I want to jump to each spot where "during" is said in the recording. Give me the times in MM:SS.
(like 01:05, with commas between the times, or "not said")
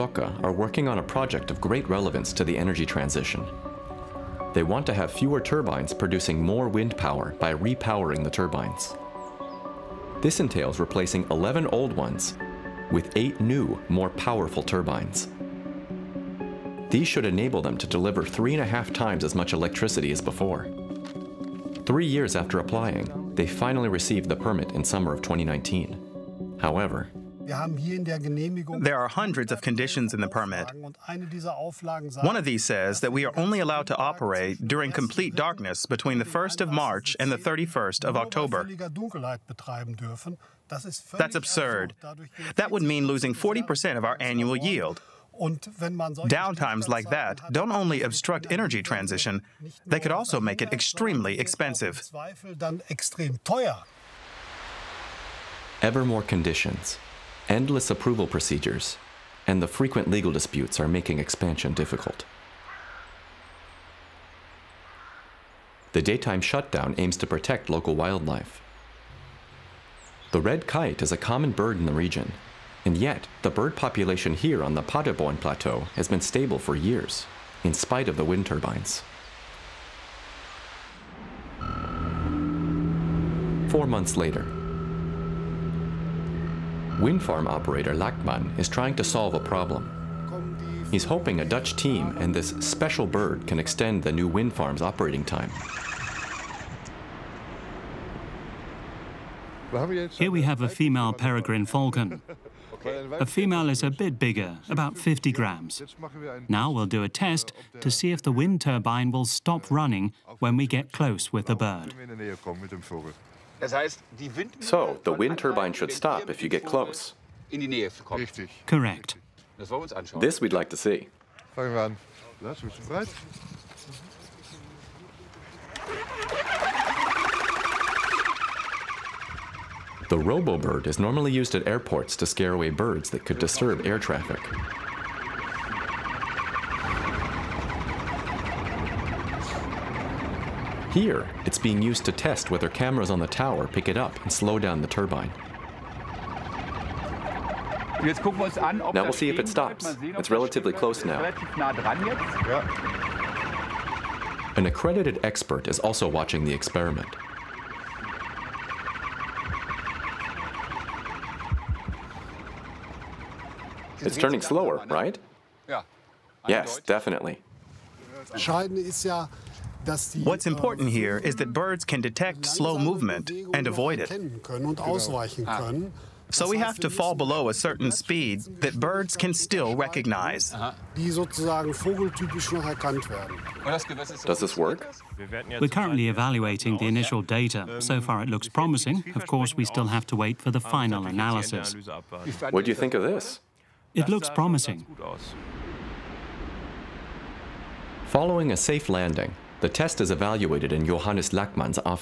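00:34.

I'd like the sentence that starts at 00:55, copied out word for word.
Ever more conditions, endless approval procedures, and the frequent legal disputes are making expansion difficult.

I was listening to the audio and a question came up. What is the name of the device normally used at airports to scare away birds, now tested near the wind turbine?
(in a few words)
RoboBird.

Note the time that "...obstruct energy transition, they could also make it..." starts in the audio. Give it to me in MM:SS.
00:48.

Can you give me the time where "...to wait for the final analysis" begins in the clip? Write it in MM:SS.
03:10.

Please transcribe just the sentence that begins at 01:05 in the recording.
The daytime shutdown aims to protect local wildlife.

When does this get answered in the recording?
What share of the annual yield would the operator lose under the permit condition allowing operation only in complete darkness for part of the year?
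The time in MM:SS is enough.
00:43.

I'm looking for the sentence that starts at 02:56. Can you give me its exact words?
So we have to fall below a certain speed that birds can still recognize.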